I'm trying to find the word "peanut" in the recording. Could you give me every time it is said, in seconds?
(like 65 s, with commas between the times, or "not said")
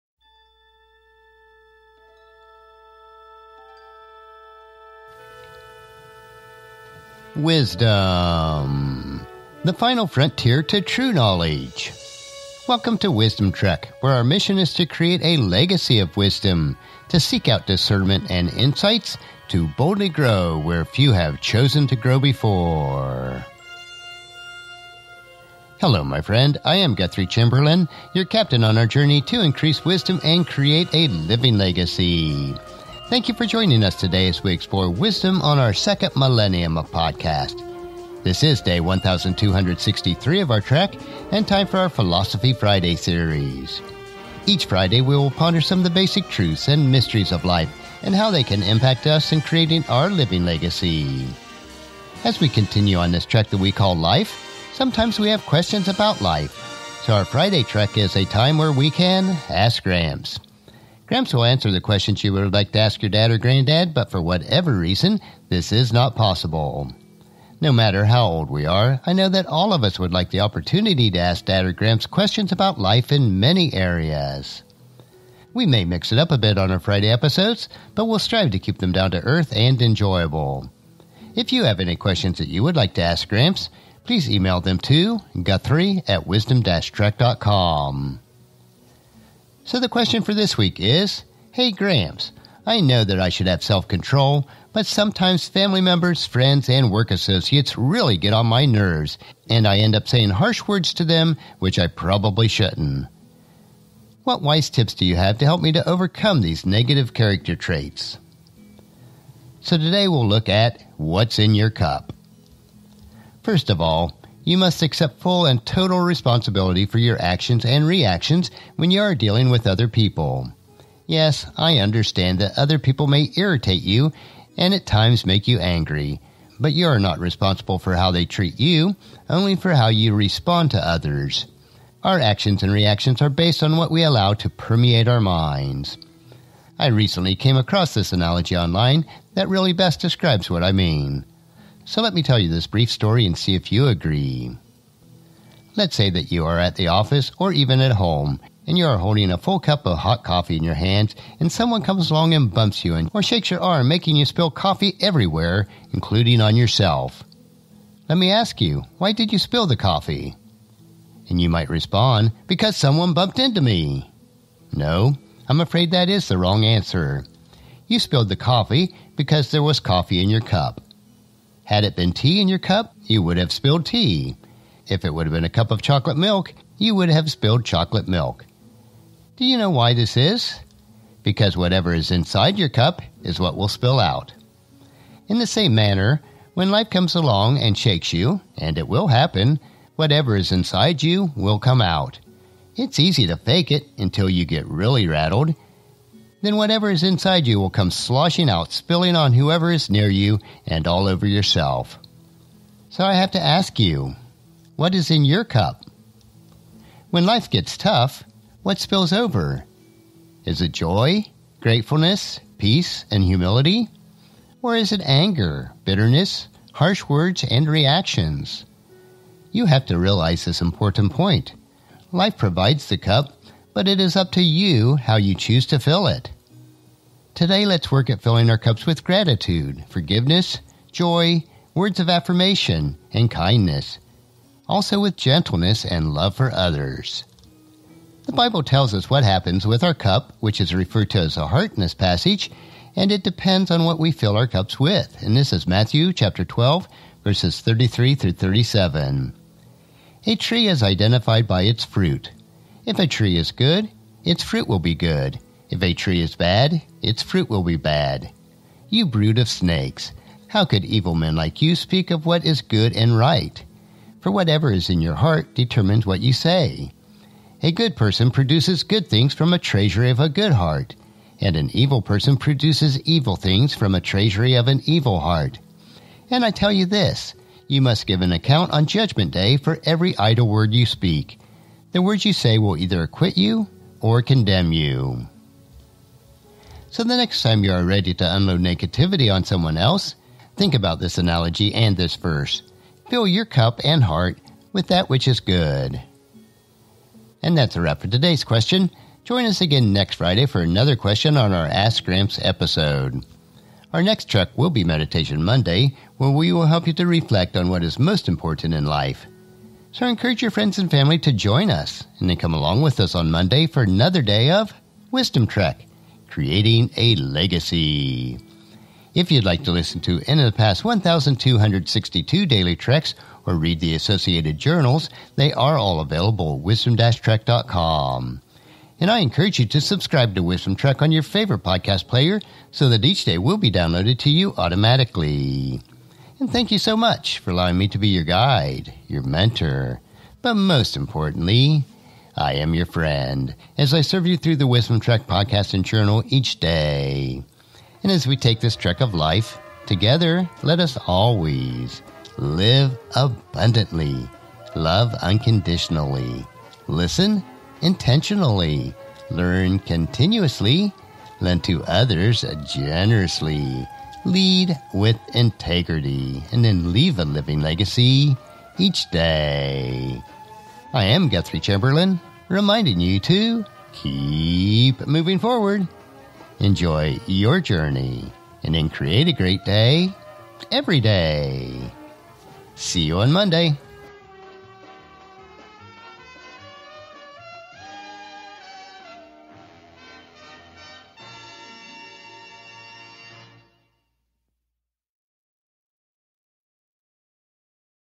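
not said.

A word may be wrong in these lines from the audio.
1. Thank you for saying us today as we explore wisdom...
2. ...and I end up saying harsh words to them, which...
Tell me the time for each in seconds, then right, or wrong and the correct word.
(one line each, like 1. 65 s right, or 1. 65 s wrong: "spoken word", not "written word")
1. 33 s wrong: "joining", not "saying"
2. 99 s right.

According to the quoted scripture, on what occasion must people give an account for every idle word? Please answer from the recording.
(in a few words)
Judgment Day.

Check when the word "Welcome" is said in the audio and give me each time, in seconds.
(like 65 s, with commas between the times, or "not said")
12 s.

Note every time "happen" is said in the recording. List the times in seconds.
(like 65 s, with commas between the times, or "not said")
189 s, 239 s.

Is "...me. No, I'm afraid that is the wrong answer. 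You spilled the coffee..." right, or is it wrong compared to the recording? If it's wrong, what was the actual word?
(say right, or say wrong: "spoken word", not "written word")
right.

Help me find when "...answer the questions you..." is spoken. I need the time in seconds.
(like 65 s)
61 s.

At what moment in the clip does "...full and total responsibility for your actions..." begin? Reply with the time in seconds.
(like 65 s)
115 s.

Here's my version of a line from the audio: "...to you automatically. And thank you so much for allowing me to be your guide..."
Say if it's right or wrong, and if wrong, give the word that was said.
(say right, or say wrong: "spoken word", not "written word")
right.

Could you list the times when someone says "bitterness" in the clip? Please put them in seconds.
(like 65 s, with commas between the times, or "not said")
215 s.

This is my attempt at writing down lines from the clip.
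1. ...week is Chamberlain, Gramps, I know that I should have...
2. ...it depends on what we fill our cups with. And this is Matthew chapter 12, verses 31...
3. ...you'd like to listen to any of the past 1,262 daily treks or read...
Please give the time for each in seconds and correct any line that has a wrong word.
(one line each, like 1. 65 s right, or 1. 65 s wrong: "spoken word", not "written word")
1. 90 s wrong: "Hey", not "Chamberlain"
2. 243 s wrong: "33", not "31"
3. 319 s right.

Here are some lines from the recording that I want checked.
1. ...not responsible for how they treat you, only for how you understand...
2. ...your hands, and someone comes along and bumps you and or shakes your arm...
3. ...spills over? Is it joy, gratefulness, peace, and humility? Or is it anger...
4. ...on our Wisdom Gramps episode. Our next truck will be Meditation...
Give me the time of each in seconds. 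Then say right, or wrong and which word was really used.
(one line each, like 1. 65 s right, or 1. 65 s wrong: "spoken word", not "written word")
1. 126 s wrong: "respond", not "understand"
2. 150 s right
3. 208 s right
4. 301 s wrong: "Ask", not "Wisdom".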